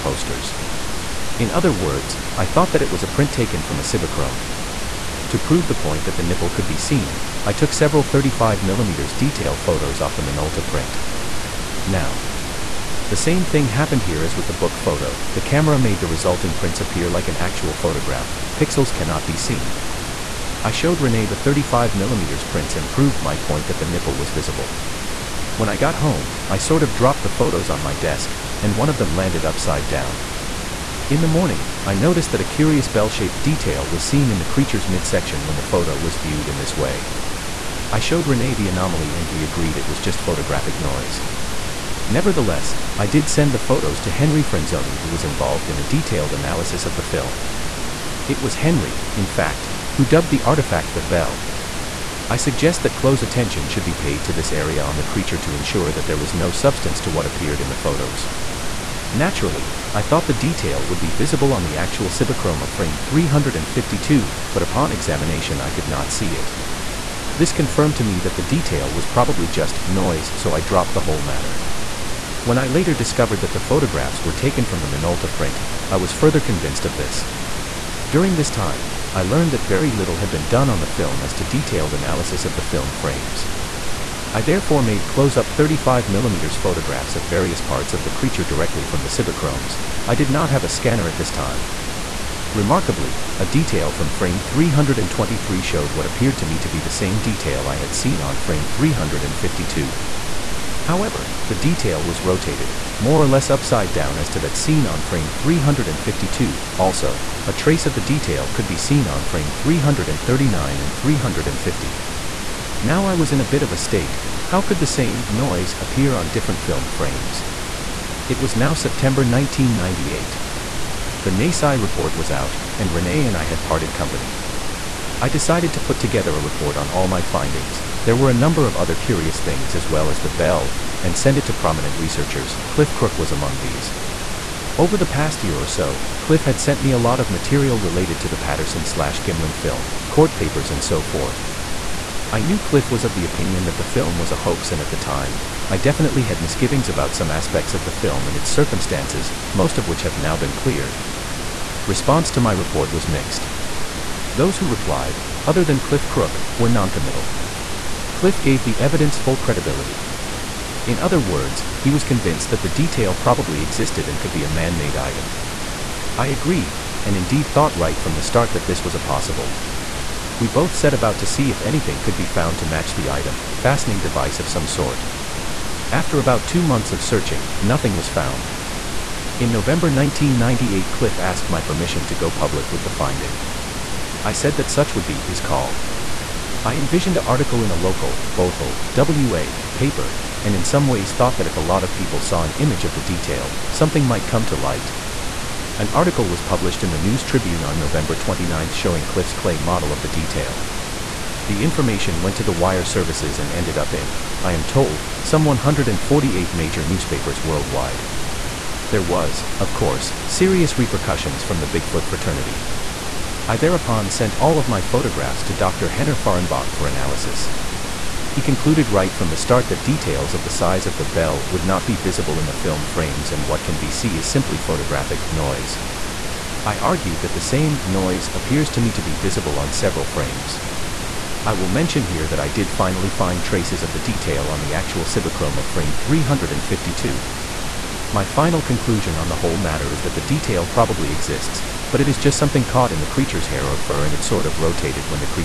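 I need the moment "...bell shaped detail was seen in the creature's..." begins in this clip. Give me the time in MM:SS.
00:32.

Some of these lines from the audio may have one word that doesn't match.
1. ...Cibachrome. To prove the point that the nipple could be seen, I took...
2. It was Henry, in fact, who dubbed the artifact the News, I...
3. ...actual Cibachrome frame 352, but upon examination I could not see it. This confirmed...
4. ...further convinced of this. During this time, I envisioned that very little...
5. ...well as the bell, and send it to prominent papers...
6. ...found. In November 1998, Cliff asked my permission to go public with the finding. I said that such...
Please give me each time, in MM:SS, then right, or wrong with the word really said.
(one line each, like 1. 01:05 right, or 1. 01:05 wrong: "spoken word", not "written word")
1. 00:03 right
2. 00:48 wrong: "Bell", not "News"
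3. 01:01 right
4. 01:16 wrong: "learned", not "envisioned"
5. 02:09 wrong: "researchers", not "papers"
6. 02:58 right.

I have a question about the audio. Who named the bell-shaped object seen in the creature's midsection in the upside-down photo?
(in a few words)
Henry Franzoni.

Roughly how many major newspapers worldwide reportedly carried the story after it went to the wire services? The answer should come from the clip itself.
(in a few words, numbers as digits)
148.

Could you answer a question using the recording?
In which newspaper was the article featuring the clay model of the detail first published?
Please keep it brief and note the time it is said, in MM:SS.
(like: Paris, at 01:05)
News Tribune, at 03:16.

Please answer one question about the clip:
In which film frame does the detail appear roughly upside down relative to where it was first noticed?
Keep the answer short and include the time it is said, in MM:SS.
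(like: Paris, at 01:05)
323, at 01:34.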